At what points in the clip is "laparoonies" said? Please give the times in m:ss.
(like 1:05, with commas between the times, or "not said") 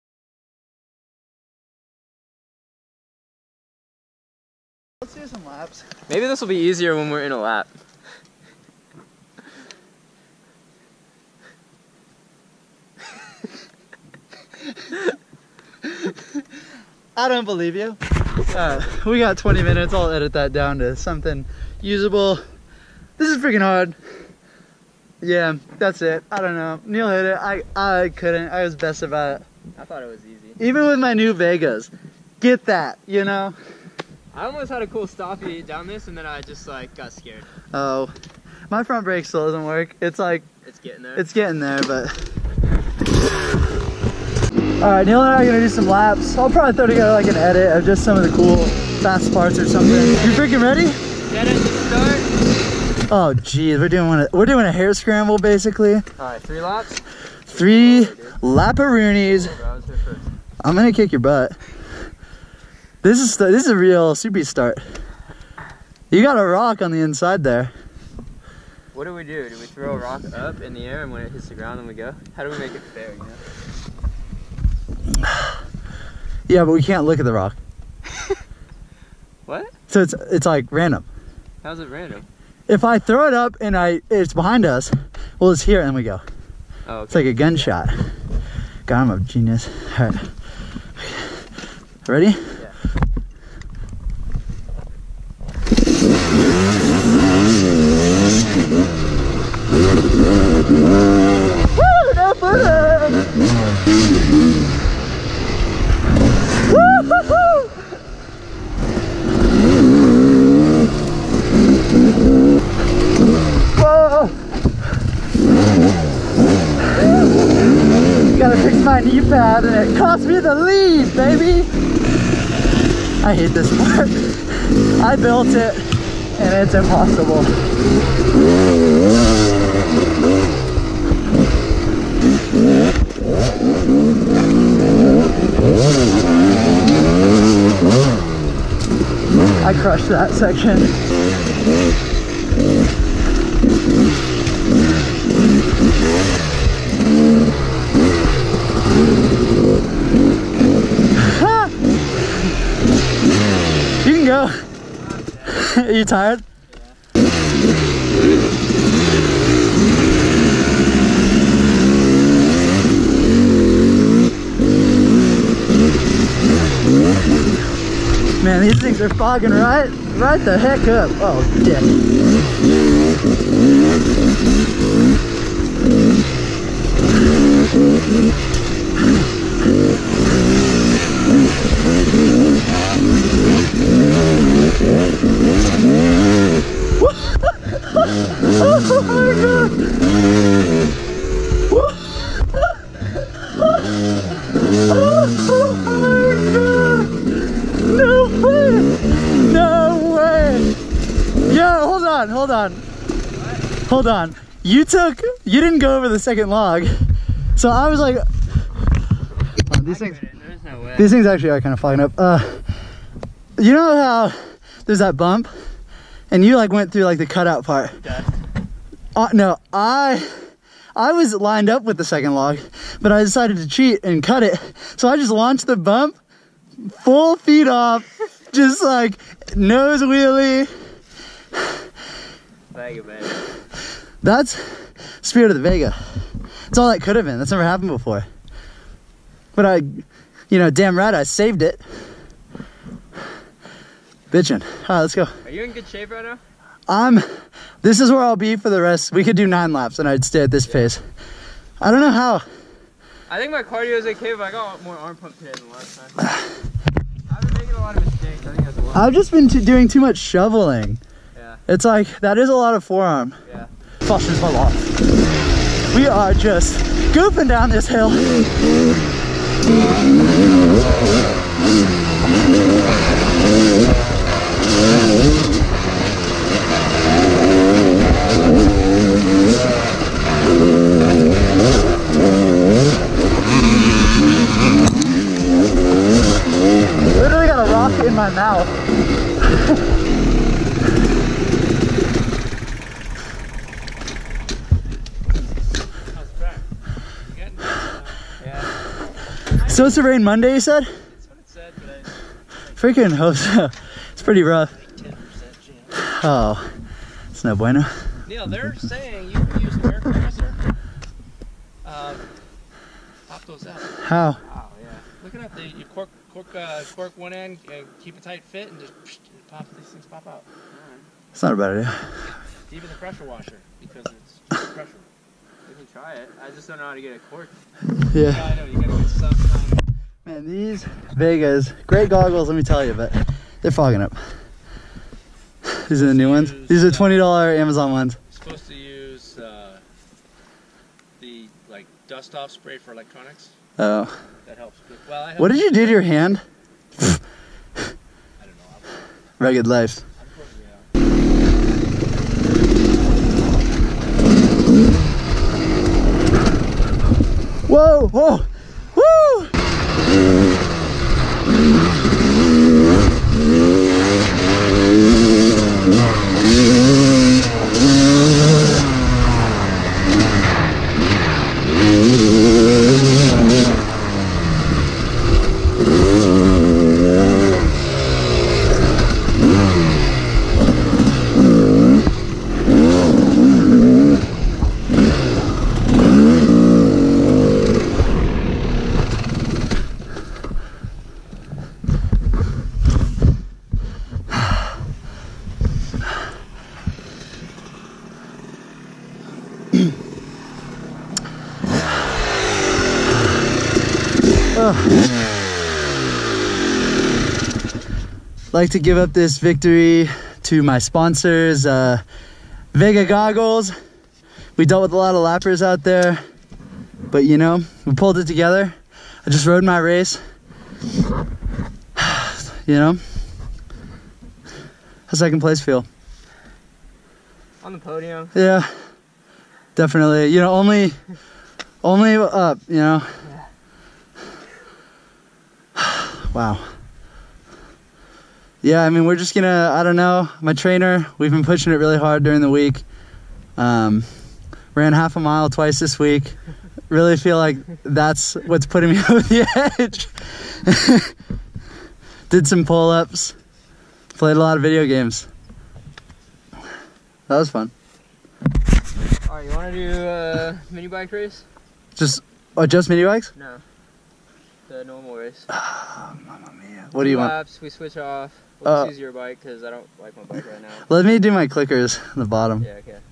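0:58.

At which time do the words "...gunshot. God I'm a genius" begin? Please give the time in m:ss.
1:27.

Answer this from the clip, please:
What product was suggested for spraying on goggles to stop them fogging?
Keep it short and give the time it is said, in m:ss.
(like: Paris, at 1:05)
Dust off spray, at 5:42.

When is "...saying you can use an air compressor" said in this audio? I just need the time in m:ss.
5:08.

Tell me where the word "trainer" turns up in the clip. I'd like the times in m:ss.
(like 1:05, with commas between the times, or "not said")
7:20.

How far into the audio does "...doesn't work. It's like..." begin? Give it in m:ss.
0:39.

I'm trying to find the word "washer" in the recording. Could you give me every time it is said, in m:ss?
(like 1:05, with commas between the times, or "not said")
5:23.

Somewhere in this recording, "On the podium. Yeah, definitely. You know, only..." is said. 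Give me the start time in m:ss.
7:07.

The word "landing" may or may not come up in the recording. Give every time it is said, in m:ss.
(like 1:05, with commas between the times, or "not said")
not said.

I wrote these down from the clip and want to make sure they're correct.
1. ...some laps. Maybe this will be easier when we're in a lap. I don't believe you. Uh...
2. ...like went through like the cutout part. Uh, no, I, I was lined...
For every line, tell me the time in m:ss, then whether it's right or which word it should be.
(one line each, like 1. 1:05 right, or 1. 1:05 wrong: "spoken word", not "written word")
1. 0:05 right
2. 3:36 right.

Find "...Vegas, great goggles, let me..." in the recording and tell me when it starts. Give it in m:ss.
5:31.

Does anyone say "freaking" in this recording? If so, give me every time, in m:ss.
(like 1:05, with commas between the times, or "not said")
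0:23, 0:50, 5:02.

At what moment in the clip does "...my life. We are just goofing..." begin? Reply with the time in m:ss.
4:24.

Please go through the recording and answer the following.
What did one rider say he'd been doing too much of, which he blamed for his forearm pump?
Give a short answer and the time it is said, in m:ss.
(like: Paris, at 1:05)
Shoveling, at 4:20.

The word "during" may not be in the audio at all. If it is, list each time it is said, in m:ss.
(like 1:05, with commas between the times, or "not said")
7:22.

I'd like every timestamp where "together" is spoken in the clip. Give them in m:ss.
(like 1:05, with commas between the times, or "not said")
0:46, 6:58.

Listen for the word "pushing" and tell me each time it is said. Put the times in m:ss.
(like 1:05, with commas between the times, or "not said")
7:21.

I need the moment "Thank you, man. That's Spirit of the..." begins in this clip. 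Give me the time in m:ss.
3:52.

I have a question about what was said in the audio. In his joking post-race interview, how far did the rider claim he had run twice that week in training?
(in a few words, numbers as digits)
Half a mile.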